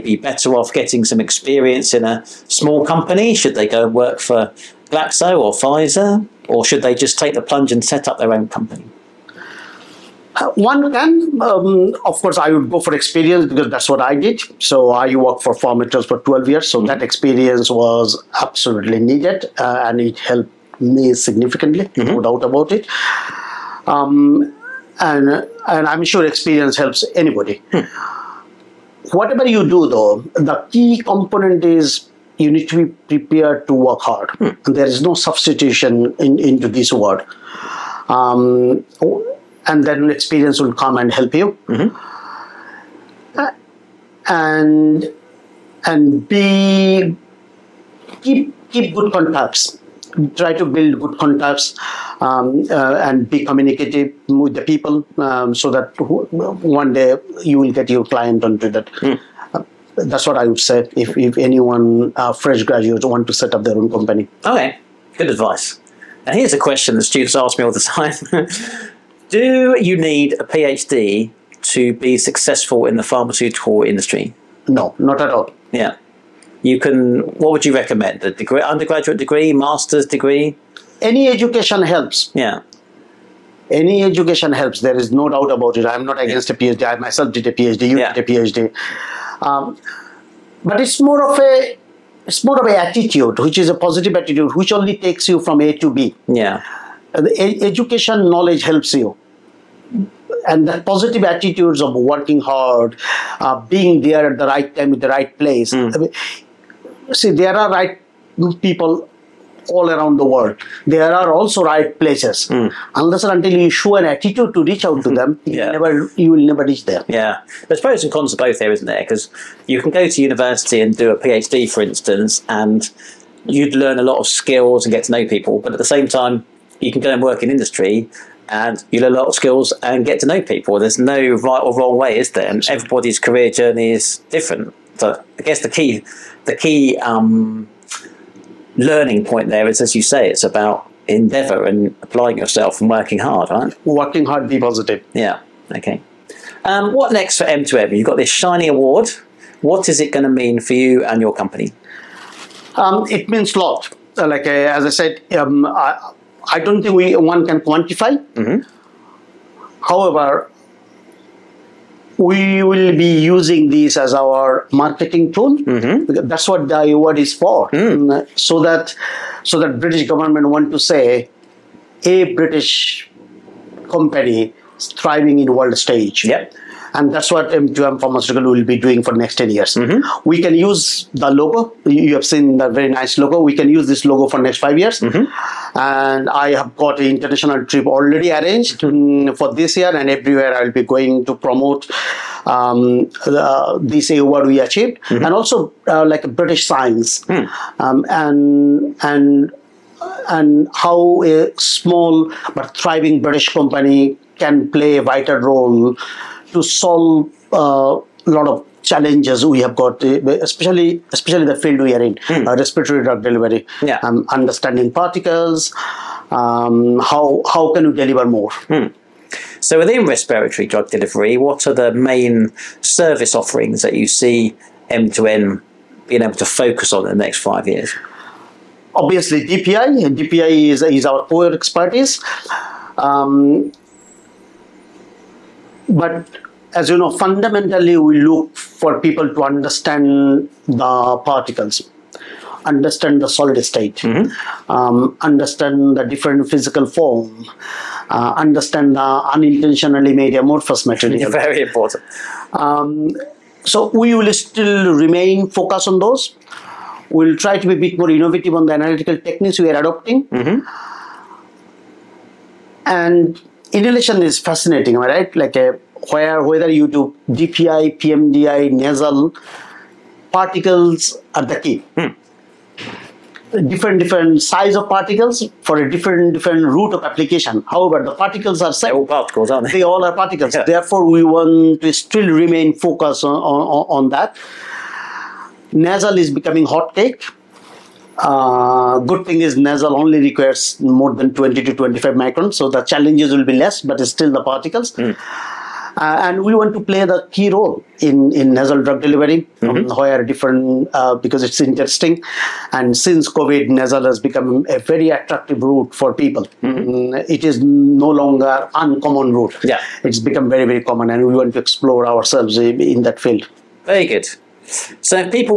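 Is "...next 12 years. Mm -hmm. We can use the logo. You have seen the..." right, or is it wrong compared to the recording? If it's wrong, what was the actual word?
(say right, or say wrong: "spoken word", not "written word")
wrong: "10", not "12".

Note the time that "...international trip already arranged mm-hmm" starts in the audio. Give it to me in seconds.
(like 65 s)
187 s.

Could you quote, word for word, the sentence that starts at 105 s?
Mm see there are right people all around the world.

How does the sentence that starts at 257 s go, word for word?
We'll try to be a bit more innovative on the analytical techniques we are adopting.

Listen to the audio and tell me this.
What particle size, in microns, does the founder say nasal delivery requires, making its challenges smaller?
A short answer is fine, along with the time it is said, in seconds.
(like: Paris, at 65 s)
20 to 25, at 291 s.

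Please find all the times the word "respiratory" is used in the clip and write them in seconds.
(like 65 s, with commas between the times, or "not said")
212 s, 220 s.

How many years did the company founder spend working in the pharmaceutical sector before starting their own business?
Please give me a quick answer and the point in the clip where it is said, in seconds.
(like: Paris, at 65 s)
12, at 16 s.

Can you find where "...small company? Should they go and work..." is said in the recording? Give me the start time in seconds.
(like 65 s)
2 s.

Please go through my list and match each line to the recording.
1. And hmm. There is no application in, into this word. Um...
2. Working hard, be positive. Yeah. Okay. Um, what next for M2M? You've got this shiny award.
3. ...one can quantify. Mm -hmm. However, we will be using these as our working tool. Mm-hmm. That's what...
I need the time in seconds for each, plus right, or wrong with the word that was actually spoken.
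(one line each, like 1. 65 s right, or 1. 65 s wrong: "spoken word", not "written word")
1. 34 s wrong: "substitution", not "application"
2. 143 s right
3. 157 s wrong: "marketing", not "working".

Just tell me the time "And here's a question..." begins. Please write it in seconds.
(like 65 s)
66 s.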